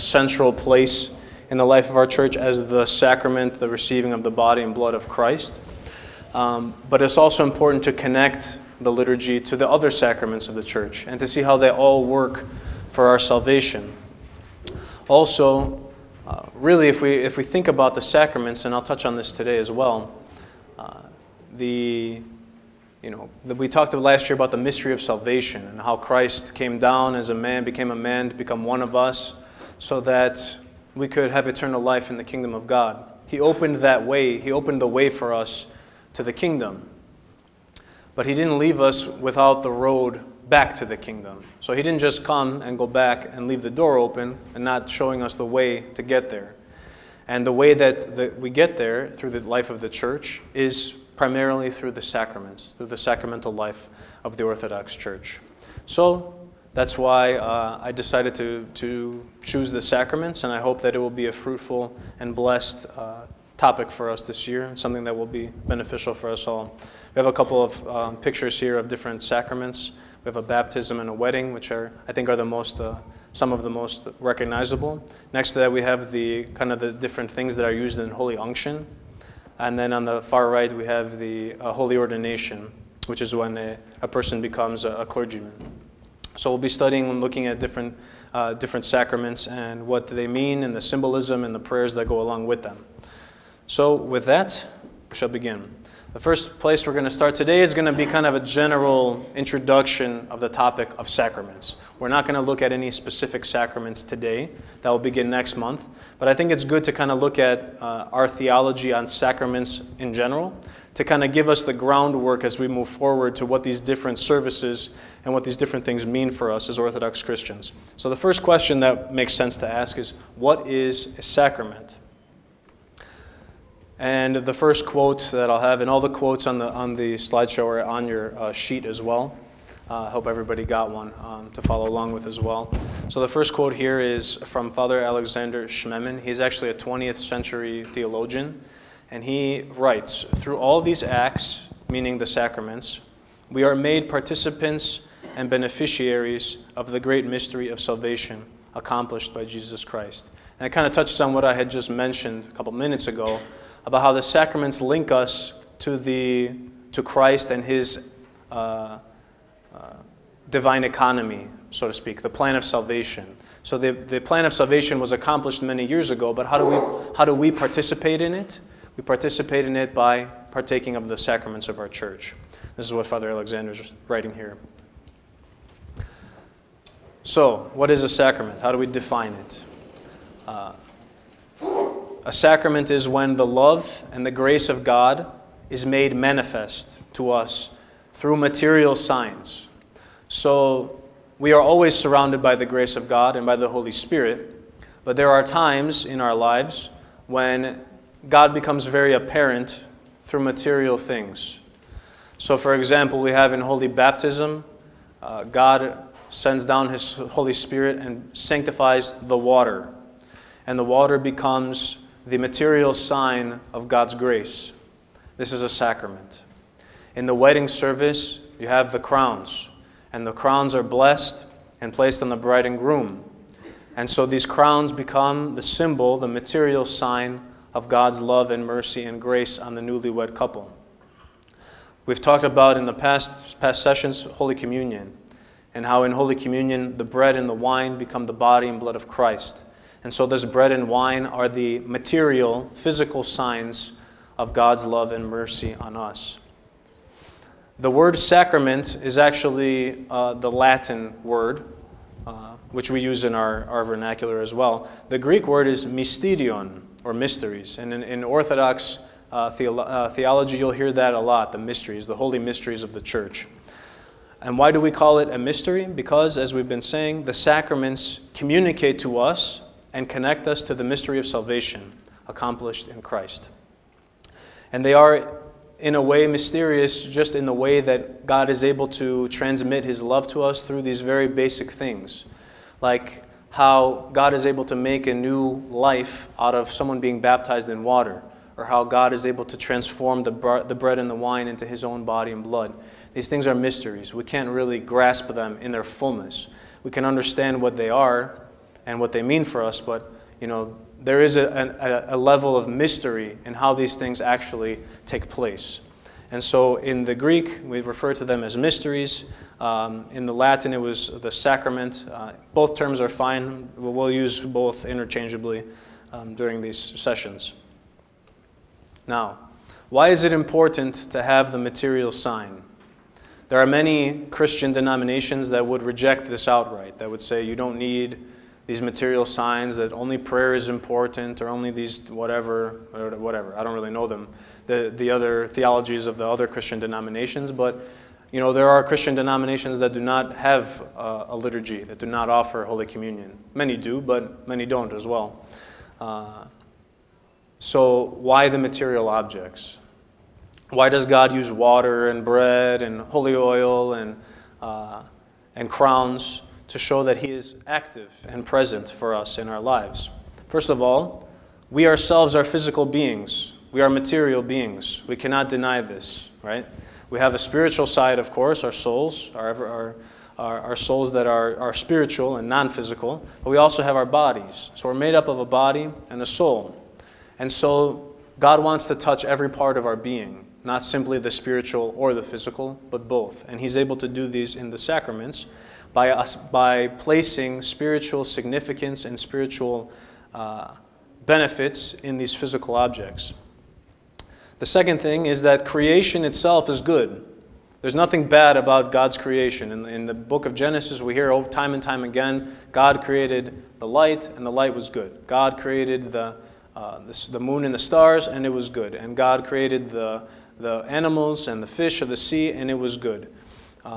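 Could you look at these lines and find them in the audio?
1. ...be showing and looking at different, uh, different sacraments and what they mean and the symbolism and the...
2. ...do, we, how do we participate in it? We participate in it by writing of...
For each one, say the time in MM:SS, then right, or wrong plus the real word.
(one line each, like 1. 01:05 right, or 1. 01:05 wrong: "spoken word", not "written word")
1. 01:26 wrong: "studying", not "showing"
2. 02:46 wrong: "partaking", not "writing".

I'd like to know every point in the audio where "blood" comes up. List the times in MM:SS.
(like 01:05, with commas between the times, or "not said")
00:04, 03:58, 04:52.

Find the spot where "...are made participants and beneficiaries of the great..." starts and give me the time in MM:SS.
02:23.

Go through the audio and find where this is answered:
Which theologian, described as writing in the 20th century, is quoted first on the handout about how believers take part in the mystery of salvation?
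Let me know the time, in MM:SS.
02:14.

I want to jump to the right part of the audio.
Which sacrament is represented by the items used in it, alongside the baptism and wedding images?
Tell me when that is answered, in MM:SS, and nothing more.
01:18.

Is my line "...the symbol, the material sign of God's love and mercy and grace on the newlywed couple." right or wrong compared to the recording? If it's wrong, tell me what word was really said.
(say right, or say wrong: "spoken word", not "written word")
right.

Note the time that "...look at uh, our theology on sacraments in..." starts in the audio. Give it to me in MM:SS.
01:47.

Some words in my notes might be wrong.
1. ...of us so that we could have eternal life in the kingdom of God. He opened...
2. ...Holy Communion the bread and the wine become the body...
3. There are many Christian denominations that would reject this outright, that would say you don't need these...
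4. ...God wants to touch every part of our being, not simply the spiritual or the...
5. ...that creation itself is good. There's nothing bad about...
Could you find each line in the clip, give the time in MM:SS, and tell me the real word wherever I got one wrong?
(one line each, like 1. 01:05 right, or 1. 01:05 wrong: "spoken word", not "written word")
1. 00:28 right
2. 03:56 right
3. 05:23 right
4. 06:18 right
5. 06:35 right.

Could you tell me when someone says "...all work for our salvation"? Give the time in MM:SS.
00:11.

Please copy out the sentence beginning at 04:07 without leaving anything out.
The word sacrament is actually uh, the Latin word, uh, which we use in our, our vernacular as well.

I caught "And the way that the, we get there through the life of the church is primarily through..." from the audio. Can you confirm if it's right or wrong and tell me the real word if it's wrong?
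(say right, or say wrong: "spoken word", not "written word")
right.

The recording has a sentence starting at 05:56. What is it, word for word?
to show that He is active and present for us in our lives.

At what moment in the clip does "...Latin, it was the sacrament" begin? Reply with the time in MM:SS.
05:10.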